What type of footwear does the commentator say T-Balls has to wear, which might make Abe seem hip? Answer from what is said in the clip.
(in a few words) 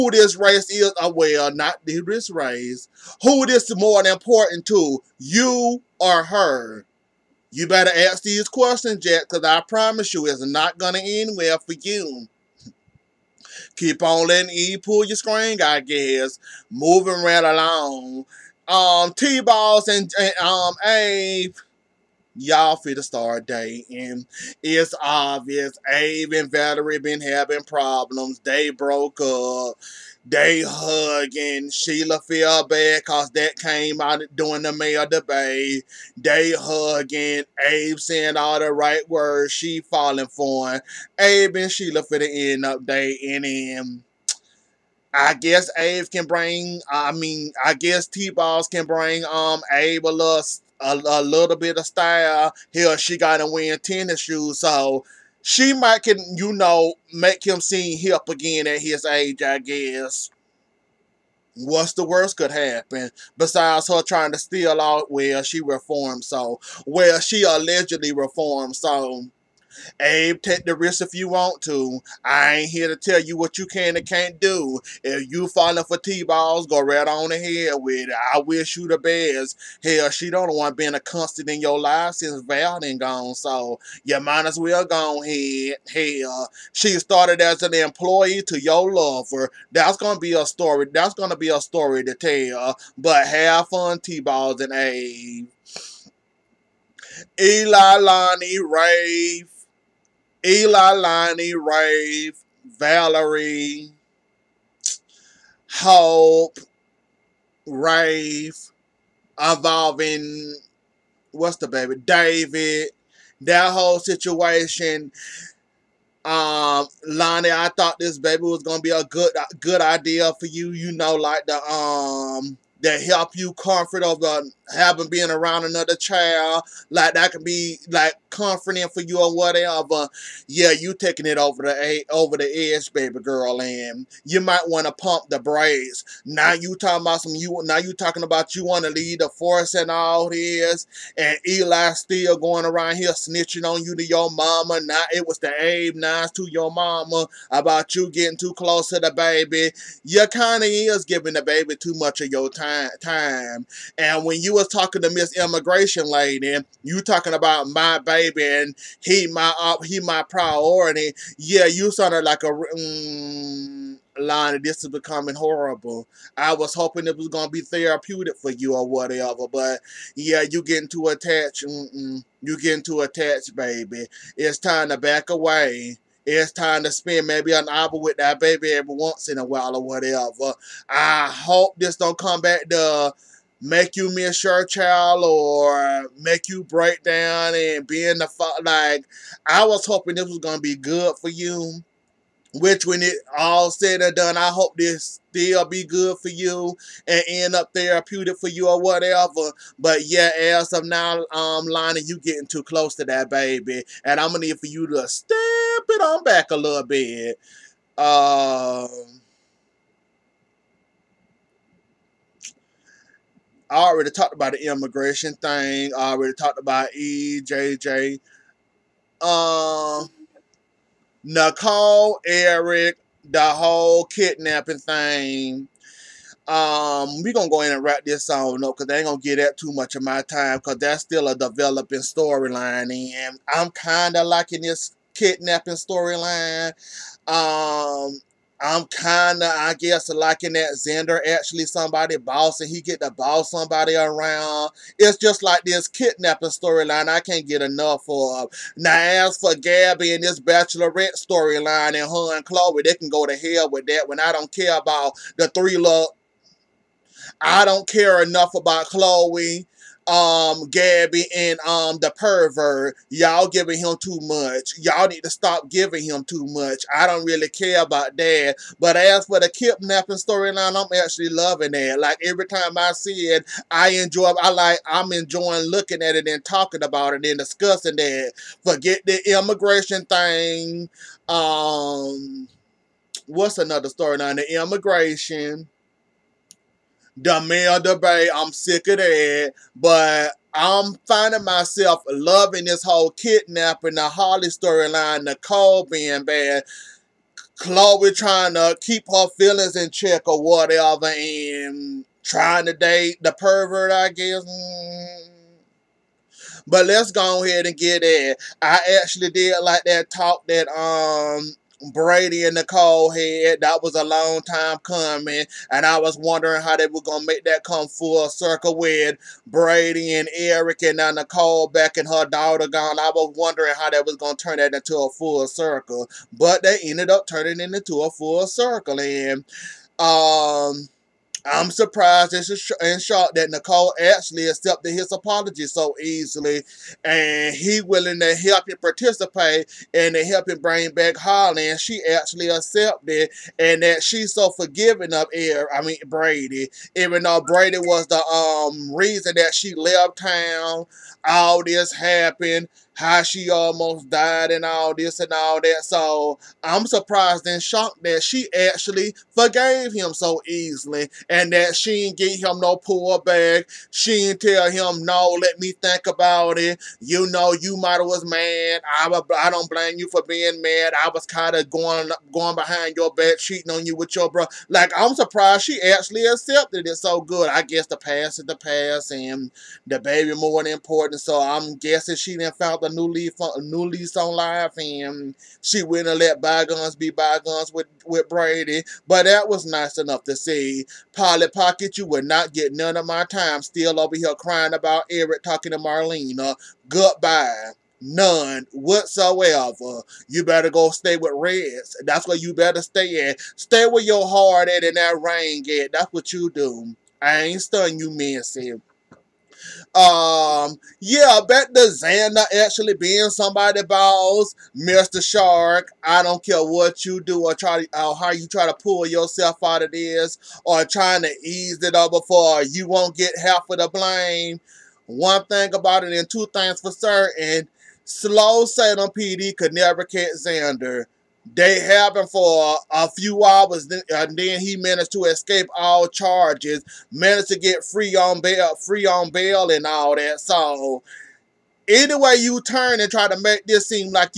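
Tennis shoes.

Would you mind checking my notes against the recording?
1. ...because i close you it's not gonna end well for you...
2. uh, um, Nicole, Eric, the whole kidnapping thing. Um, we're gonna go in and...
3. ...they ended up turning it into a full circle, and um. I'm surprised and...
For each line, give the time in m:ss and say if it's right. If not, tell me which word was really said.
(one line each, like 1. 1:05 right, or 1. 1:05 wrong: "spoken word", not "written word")
1. 0:09 wrong: "promise", not "close"
2. 3:39 right
3. 5:26 right.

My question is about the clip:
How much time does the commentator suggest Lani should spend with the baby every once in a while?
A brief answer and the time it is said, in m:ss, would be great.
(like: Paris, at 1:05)
An hour, at 2:57.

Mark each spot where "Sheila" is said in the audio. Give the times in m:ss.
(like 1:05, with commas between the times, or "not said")
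0:31, 0:41.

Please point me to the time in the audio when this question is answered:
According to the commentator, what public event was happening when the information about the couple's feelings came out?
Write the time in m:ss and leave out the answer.
0:34.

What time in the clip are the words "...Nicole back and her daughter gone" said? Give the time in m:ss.
5:21.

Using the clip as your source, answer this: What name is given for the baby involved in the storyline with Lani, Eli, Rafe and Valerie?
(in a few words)
David.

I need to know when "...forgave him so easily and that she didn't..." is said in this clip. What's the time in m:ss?
5:59.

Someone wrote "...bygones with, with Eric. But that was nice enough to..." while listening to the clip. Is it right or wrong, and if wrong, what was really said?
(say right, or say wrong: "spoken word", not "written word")
wrong: "Brady", not "Eric".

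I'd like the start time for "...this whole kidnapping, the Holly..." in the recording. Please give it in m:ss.
4:52.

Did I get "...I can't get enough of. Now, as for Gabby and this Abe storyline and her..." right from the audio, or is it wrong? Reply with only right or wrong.
wrong.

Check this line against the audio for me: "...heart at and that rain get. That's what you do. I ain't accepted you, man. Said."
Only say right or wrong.
wrong.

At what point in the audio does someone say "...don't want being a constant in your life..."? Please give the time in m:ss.
1:20.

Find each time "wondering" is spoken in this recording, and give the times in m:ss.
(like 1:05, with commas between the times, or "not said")
5:16, 5:23.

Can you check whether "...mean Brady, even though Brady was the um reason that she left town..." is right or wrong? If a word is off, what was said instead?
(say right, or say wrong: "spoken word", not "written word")
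right.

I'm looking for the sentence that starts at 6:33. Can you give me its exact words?
Still over here crying about Eric talking to Marlena.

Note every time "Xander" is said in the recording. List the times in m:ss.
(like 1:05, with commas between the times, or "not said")
4:00, 6:51, 7:10.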